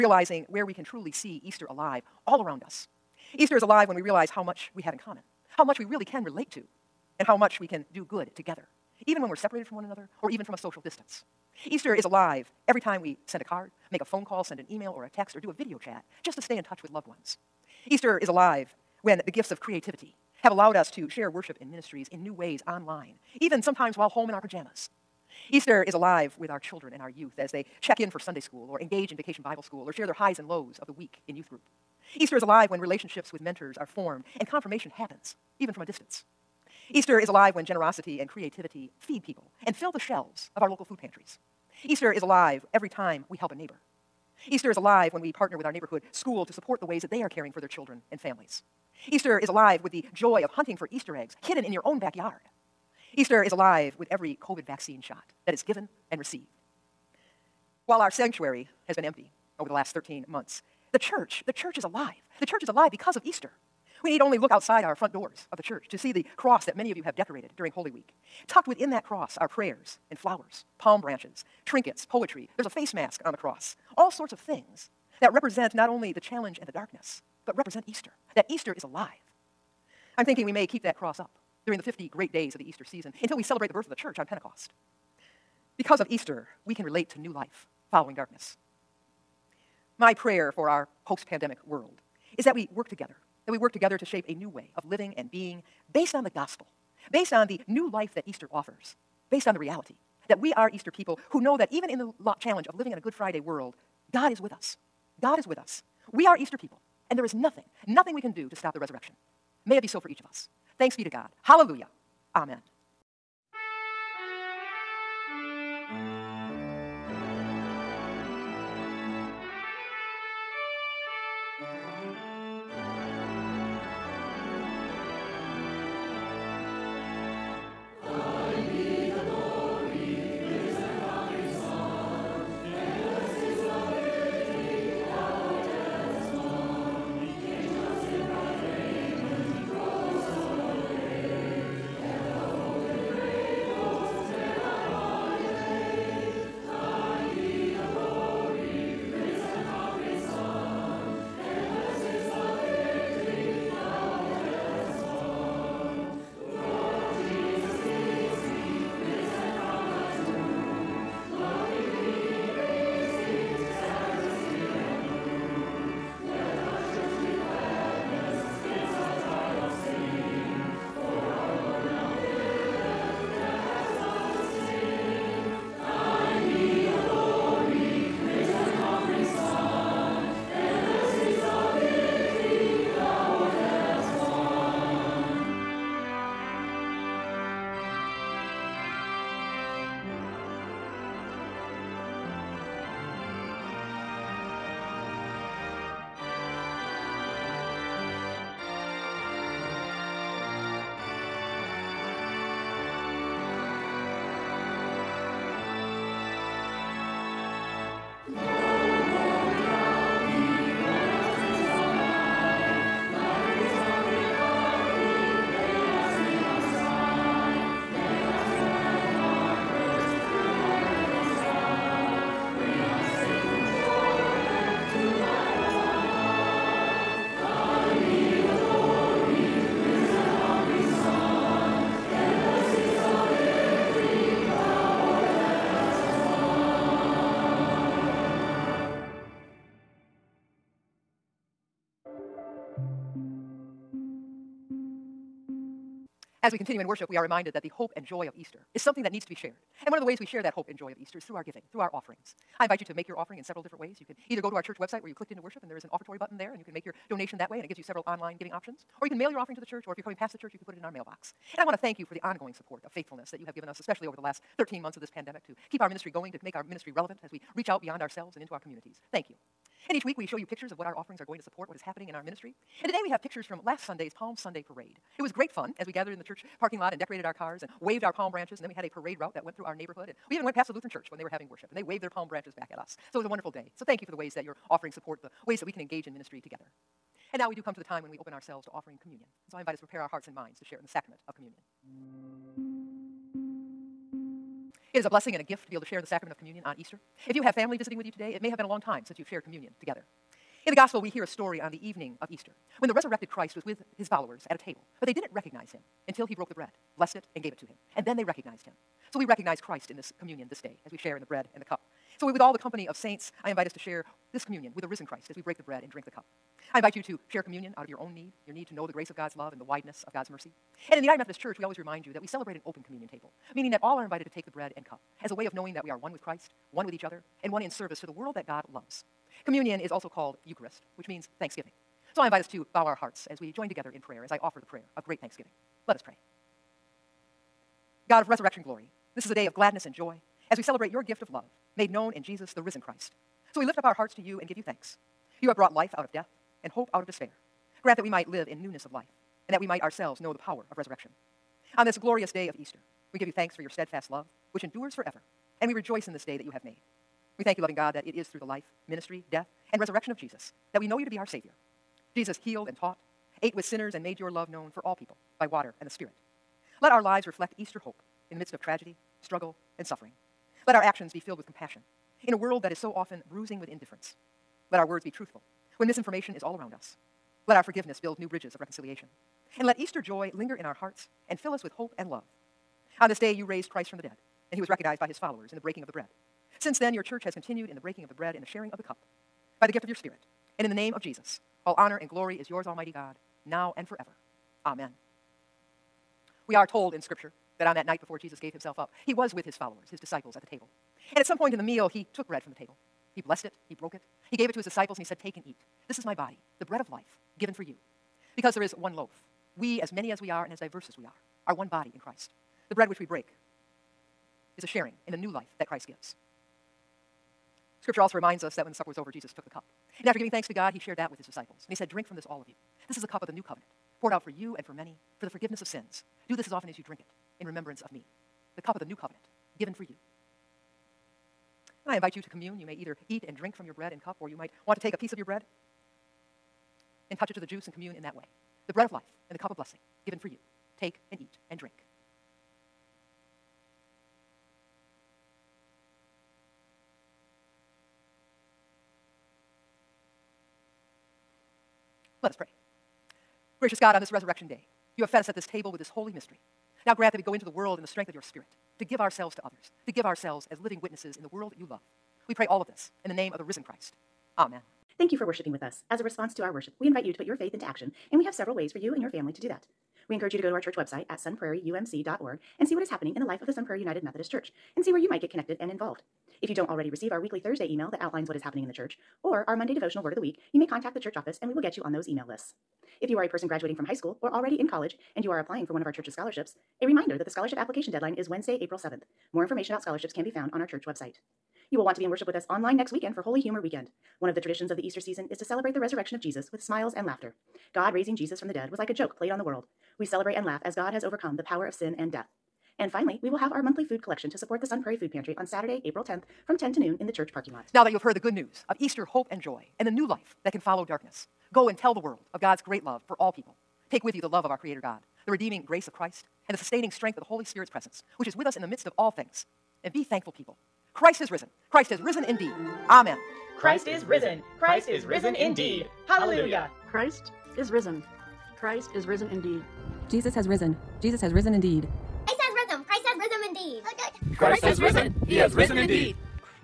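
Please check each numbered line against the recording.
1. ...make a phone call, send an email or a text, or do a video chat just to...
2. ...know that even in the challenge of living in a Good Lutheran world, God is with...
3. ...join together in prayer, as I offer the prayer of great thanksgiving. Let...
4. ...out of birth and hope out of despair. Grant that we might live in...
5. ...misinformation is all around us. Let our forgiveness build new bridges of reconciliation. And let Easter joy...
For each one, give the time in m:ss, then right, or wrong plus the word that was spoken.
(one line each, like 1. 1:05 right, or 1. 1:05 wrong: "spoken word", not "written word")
1. 0:13 right
2. 1:41 wrong: "Friday", not "Lutheran"
3. 5:33 right
4. 5:45 wrong: "death", not "birth"
5. 6:15 right.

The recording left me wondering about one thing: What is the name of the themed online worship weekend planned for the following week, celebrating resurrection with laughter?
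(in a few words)
Holy Humor Weekend.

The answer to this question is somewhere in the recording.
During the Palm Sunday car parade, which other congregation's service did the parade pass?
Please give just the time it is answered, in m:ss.
4:40.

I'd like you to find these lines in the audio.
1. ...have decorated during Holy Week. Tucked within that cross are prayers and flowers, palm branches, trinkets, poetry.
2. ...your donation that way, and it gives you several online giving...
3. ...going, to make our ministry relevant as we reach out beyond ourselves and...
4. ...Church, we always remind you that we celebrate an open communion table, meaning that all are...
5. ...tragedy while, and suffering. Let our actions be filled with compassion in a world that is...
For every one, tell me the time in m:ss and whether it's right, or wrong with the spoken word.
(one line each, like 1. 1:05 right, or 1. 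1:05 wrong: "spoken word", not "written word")
1. 1:07 right
2. 4:16 right
3. 4:26 right
4. 5:21 right
5. 6:08 wrong: "struggle", not "while".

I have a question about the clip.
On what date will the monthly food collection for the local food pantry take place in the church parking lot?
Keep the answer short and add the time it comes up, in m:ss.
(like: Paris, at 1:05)
April 10, at 8:25.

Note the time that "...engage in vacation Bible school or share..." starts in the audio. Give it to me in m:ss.
0:28.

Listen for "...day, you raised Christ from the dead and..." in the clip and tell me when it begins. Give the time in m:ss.
6:23.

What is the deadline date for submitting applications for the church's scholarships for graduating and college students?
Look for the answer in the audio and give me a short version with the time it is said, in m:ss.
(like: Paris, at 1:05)
April 7, at 8:08.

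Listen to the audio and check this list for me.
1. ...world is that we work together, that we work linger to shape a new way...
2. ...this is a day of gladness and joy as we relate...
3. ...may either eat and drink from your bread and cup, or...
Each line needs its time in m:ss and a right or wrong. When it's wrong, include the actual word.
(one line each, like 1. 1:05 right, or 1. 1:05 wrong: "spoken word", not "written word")
1. 1:31 wrong: "together", not "linger"
2. 5:39 wrong: "celebrate", not "relate"
3. 7:12 right.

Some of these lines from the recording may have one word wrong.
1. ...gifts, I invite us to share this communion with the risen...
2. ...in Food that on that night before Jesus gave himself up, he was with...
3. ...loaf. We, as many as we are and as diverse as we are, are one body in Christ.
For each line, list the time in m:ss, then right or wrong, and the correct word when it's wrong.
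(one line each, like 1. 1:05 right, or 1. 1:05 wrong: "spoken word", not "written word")
1. 5:12 wrong: "saints", not "gifts"
2. 6:36 wrong: "Scripture", not "Food"
3. 6:48 right.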